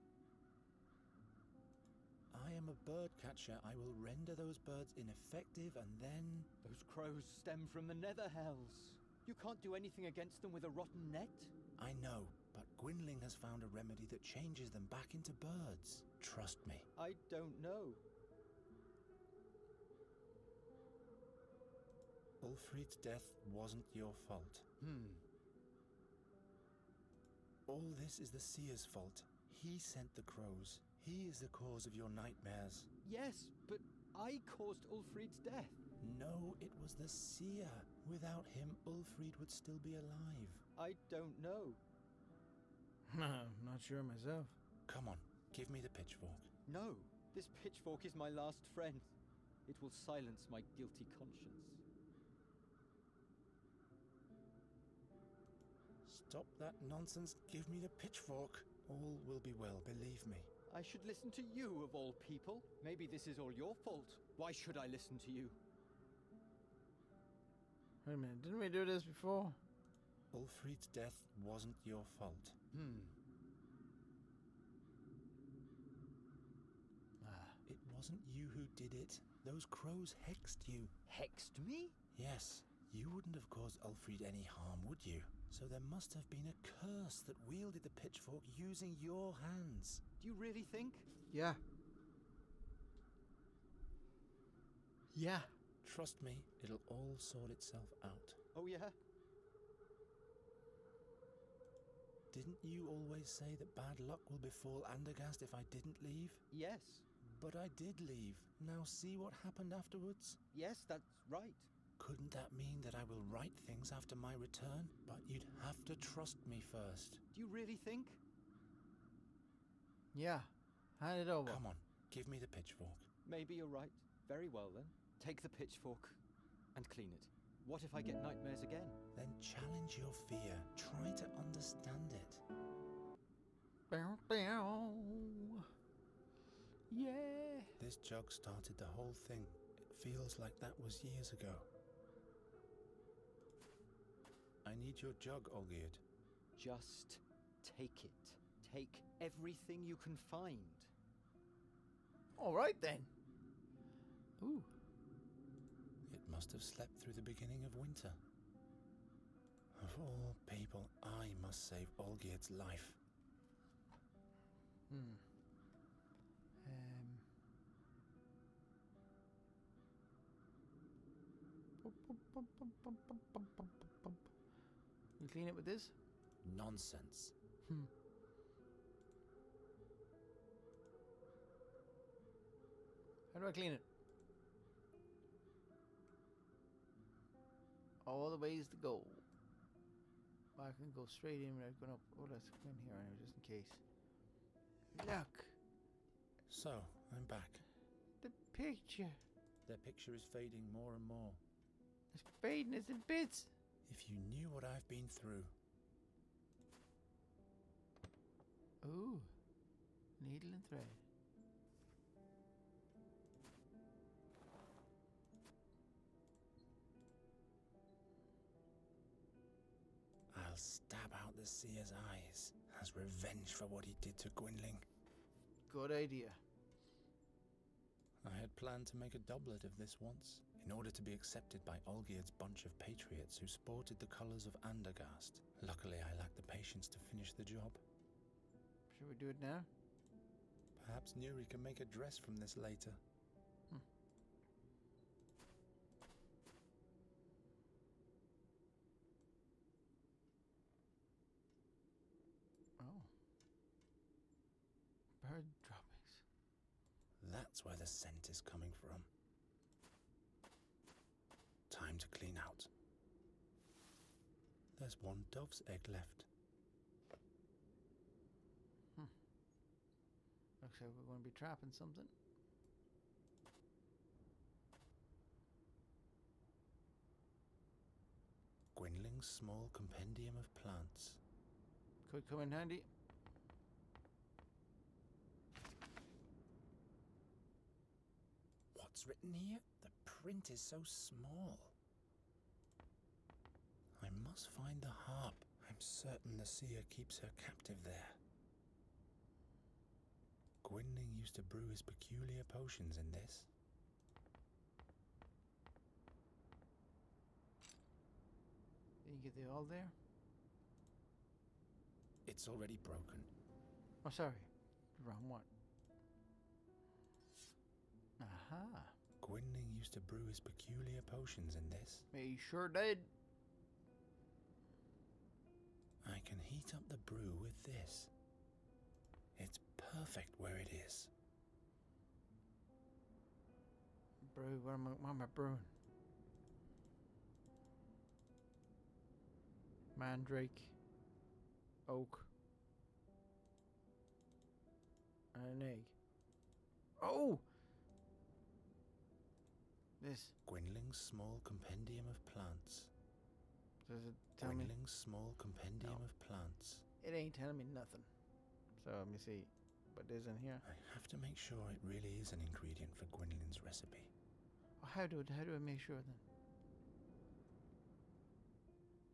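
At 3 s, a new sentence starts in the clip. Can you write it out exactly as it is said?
I will render those birds ineffective and then...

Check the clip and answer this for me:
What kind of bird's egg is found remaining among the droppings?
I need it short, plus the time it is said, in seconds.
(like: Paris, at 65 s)
Dove, at 264 s.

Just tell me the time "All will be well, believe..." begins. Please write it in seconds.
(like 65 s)
58 s.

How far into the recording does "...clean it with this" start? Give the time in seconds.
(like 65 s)
175 s.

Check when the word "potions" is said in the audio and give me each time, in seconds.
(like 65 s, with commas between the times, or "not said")
302 s, 321 s.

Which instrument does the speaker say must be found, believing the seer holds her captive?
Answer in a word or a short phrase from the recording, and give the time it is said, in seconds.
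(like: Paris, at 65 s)
The harp, at 294 s.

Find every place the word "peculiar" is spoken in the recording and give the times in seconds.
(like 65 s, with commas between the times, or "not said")
301 s, 320 s.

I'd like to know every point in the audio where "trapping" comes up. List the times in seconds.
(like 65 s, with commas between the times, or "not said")
271 s.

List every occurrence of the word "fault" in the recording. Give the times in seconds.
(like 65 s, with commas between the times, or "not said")
24 s, 28 s, 63 s, 72 s.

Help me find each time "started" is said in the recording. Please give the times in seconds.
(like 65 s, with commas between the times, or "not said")
138 s.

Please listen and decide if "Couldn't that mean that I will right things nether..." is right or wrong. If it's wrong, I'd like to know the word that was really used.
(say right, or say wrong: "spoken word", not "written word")
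wrong: "after", not "nether".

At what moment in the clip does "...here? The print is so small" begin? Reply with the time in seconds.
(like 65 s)
289 s.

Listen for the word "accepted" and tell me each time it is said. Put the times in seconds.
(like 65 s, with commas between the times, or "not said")
231 s.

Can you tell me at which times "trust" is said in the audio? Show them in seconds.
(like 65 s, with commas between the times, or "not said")
16 s, 95 s, 115 s.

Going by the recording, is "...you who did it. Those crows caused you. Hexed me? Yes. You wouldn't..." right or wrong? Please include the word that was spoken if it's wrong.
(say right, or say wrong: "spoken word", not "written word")
wrong: "hexed", not "caused".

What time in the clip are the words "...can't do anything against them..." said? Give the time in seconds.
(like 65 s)
9 s.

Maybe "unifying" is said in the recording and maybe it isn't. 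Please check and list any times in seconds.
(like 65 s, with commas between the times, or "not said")
not said.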